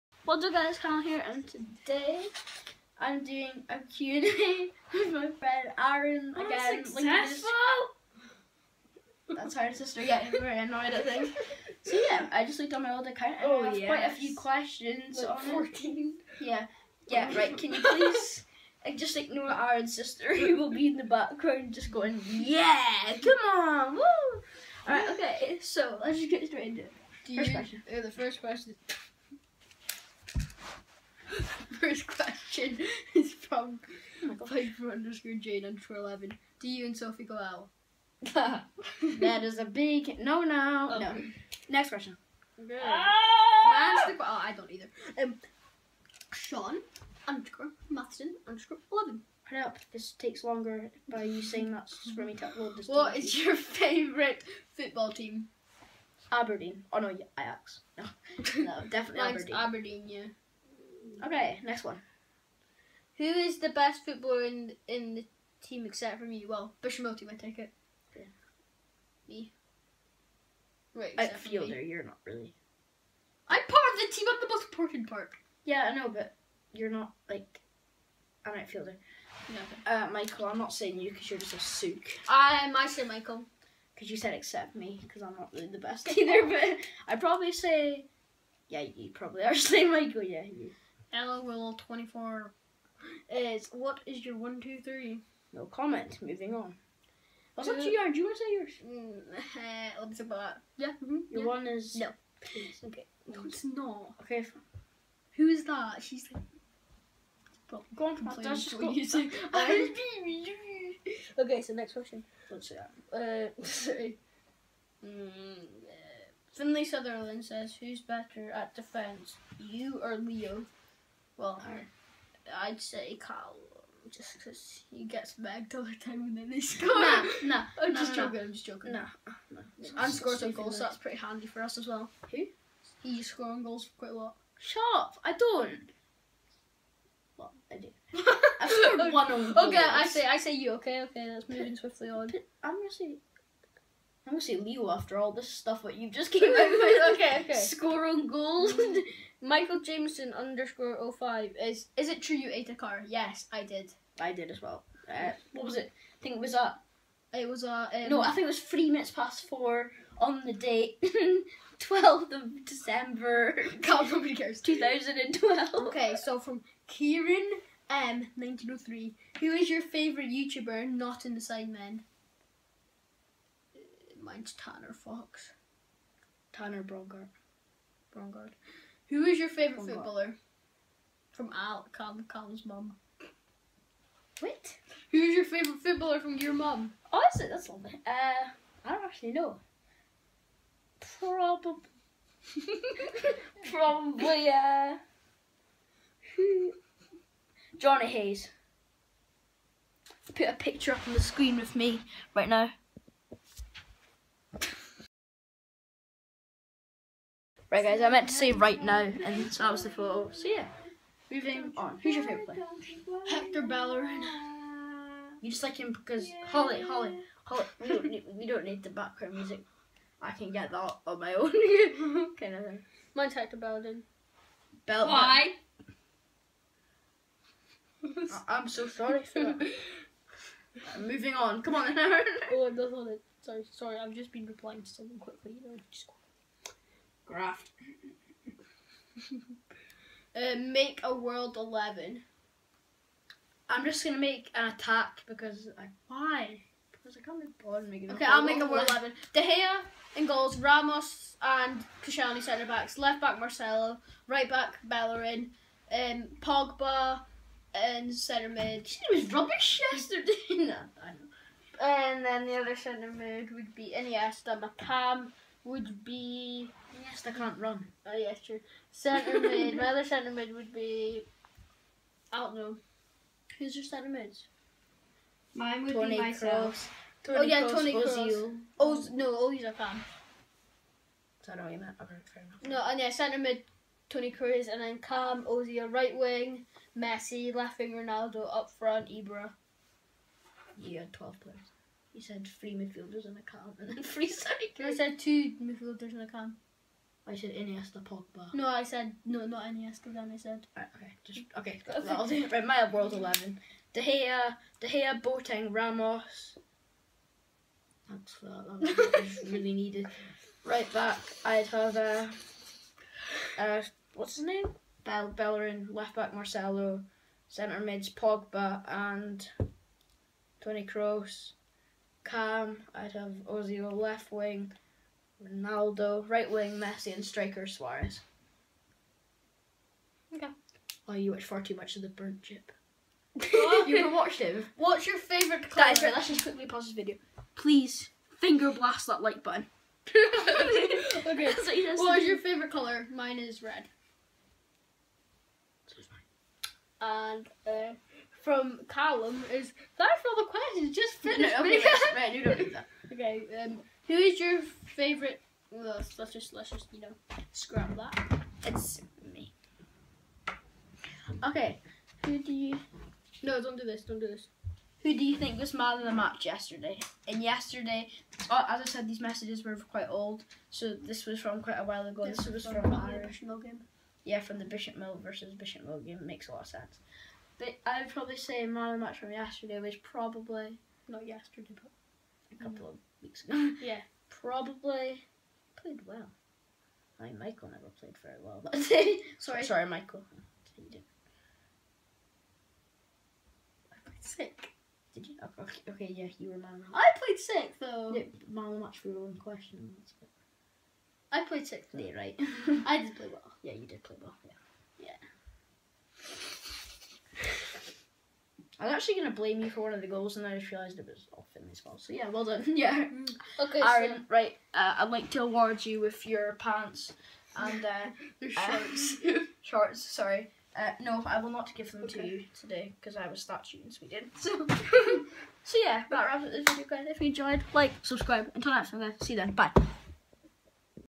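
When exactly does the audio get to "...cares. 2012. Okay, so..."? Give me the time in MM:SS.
02:44.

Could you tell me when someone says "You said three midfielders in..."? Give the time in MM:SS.
04:52.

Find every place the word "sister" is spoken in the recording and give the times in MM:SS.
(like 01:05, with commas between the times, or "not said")
00:09, 00:19.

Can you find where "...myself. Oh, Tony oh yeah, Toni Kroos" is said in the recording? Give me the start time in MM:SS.
04:36.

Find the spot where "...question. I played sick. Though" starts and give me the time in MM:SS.
06:39.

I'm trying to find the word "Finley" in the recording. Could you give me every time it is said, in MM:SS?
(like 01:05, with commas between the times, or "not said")
01:56, 06:51.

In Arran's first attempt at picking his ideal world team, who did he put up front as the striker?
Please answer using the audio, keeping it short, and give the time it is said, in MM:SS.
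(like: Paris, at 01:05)
Ibra, at 04:49.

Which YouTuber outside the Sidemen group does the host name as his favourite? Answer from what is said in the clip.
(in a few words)
Tanner Fox.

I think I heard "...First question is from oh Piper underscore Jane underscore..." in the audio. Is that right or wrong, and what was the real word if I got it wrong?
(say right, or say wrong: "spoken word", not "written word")
right.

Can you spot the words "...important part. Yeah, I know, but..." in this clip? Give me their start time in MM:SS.
01:14.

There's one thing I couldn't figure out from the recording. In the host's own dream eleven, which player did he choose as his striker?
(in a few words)
Suarez.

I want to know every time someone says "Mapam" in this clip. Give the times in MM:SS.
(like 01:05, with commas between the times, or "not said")
04:24.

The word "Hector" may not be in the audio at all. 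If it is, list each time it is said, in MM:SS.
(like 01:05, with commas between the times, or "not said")
03:33, 03:43.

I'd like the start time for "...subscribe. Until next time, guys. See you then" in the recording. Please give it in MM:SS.
07:08.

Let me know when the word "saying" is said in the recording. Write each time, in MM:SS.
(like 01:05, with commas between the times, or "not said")
00:51, 01:20, 01:29.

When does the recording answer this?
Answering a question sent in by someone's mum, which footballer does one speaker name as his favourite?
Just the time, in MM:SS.
03:17.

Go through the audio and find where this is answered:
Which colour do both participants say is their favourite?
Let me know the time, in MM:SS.
05:43.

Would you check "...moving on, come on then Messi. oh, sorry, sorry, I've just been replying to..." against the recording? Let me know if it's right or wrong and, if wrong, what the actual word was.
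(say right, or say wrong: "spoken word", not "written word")
wrong: "Arran", not "Messi".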